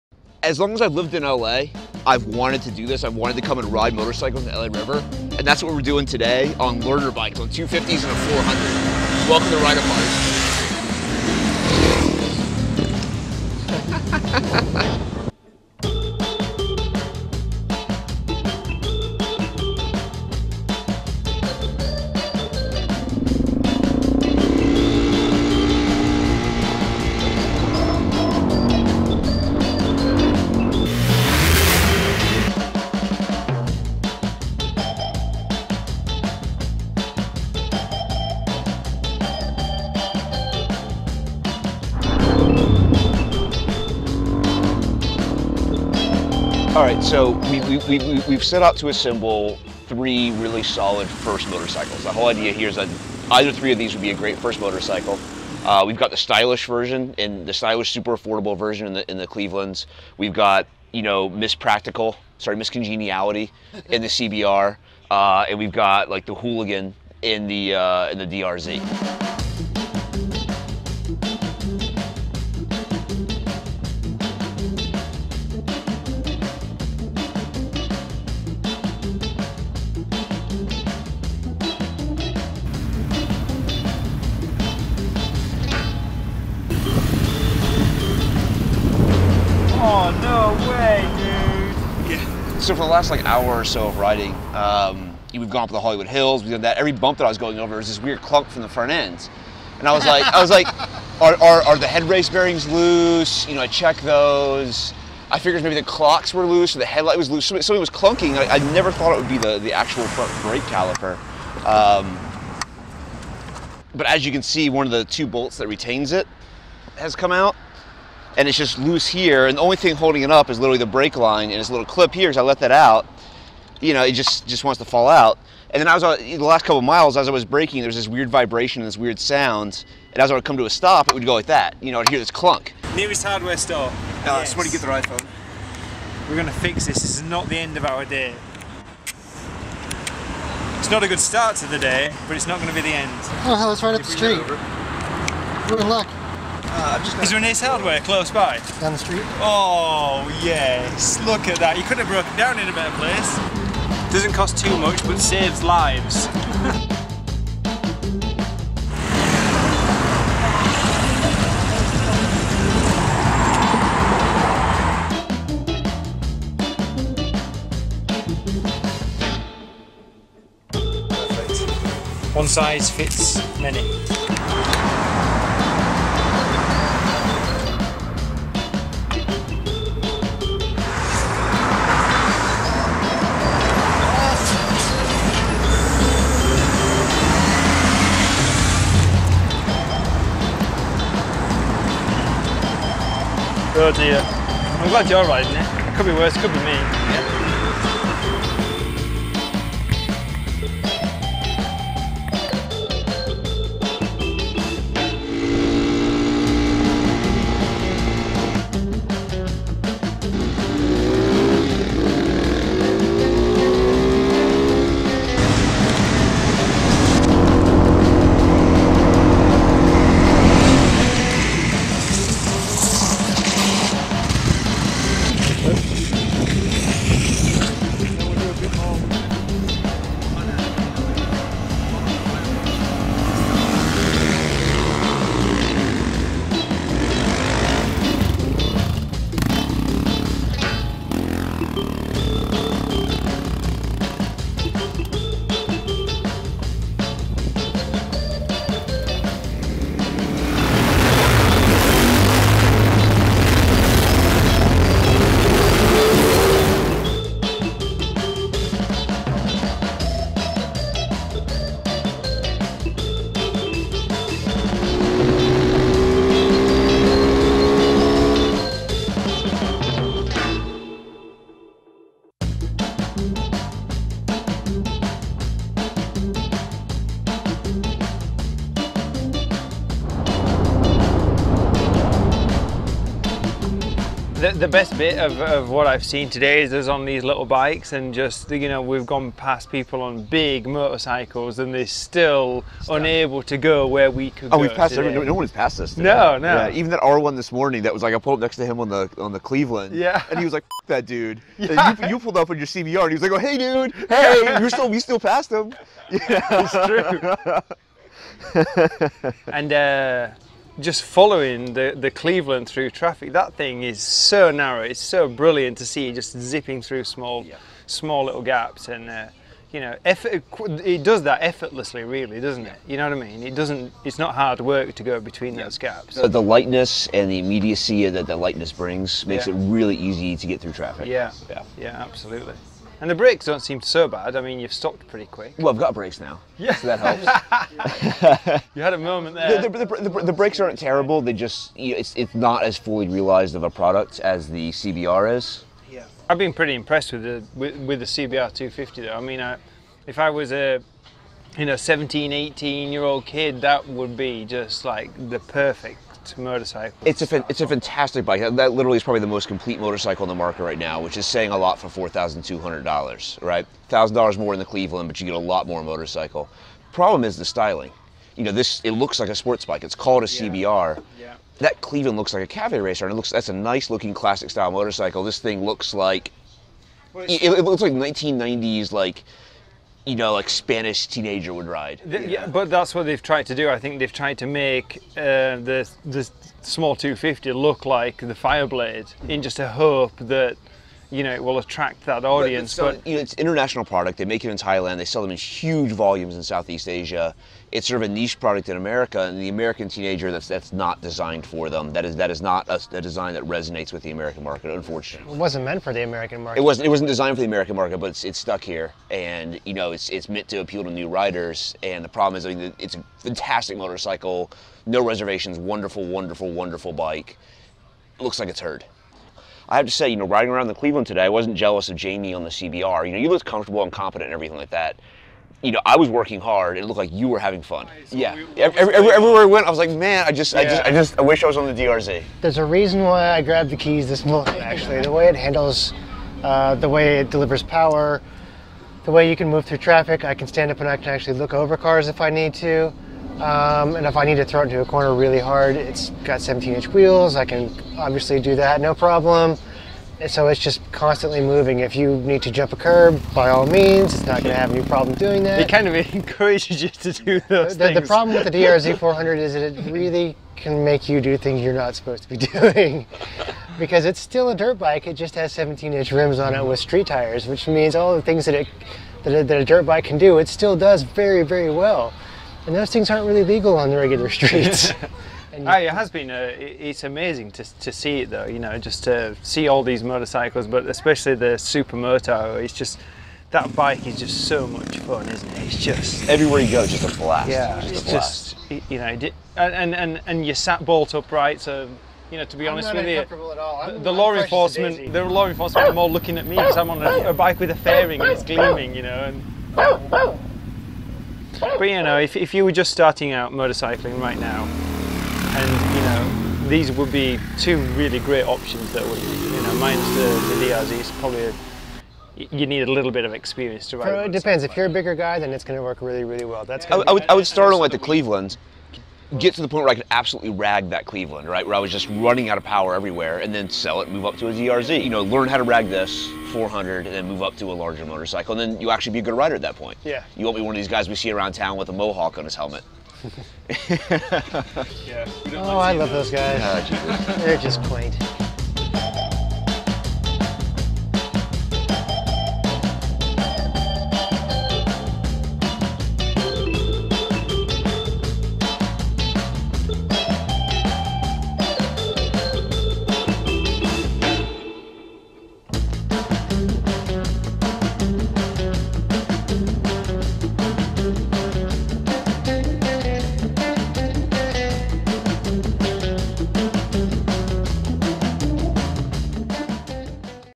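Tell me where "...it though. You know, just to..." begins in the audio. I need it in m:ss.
7:58.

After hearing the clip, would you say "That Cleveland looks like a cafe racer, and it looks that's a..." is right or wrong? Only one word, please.
right.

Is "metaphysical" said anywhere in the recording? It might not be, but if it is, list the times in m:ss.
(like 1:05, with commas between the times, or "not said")
not said.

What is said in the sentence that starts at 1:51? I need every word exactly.
Um, but as you can see, one of the two bolts that retains it has come out and it's just loose here.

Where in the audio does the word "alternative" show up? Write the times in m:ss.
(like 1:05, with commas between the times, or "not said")
not said.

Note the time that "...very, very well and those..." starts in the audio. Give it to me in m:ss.
7:51.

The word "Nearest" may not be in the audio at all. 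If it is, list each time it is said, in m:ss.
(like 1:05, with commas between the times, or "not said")
2:12.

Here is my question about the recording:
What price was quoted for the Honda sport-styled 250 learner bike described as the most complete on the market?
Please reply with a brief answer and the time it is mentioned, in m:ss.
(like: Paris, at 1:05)
$4,200, at 6:01.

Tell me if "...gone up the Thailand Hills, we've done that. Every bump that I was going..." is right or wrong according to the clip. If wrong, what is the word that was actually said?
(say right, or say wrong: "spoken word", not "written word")
wrong: "Hollywood", not "Thailand".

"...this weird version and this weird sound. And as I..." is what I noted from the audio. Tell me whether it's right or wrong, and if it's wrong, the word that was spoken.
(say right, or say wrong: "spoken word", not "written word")
wrong: "vibration", not "version".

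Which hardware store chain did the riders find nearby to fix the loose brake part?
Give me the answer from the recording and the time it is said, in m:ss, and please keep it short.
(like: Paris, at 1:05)
Ace Hardware, at 2:27.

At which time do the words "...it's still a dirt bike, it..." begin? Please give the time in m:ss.
7:44.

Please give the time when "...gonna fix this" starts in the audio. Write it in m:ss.
2:16.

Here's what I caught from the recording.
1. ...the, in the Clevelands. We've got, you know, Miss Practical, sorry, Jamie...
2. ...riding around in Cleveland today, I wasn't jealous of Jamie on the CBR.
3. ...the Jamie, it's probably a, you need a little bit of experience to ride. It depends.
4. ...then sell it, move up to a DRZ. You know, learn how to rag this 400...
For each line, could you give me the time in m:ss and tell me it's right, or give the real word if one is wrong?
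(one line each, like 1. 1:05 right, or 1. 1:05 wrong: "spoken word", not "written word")
1. 0:58 wrong: "Miss", not "Jamie"
2. 7:00 right
3. 8:30 wrong: "DRZ", not "Jamie"
4. 8:43 right.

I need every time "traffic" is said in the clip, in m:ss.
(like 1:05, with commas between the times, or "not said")
5:12, 5:30, 7:19.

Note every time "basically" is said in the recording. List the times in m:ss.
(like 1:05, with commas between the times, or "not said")
not said.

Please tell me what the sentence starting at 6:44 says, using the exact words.
Unfortunately, it wasn't meant for the American market.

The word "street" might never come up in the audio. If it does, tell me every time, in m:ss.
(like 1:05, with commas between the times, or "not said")
2:24, 2:28, 7:46, 7:54.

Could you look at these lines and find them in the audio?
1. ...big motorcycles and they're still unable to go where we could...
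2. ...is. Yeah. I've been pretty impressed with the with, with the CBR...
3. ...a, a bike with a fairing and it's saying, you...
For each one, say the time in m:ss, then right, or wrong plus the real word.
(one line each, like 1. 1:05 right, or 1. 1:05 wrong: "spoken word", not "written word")
1. 4:50 right
2. 5:45 right
3. 8:17 wrong: "gleaming", not "saying".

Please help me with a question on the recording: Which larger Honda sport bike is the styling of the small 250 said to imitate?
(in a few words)
Fireblade.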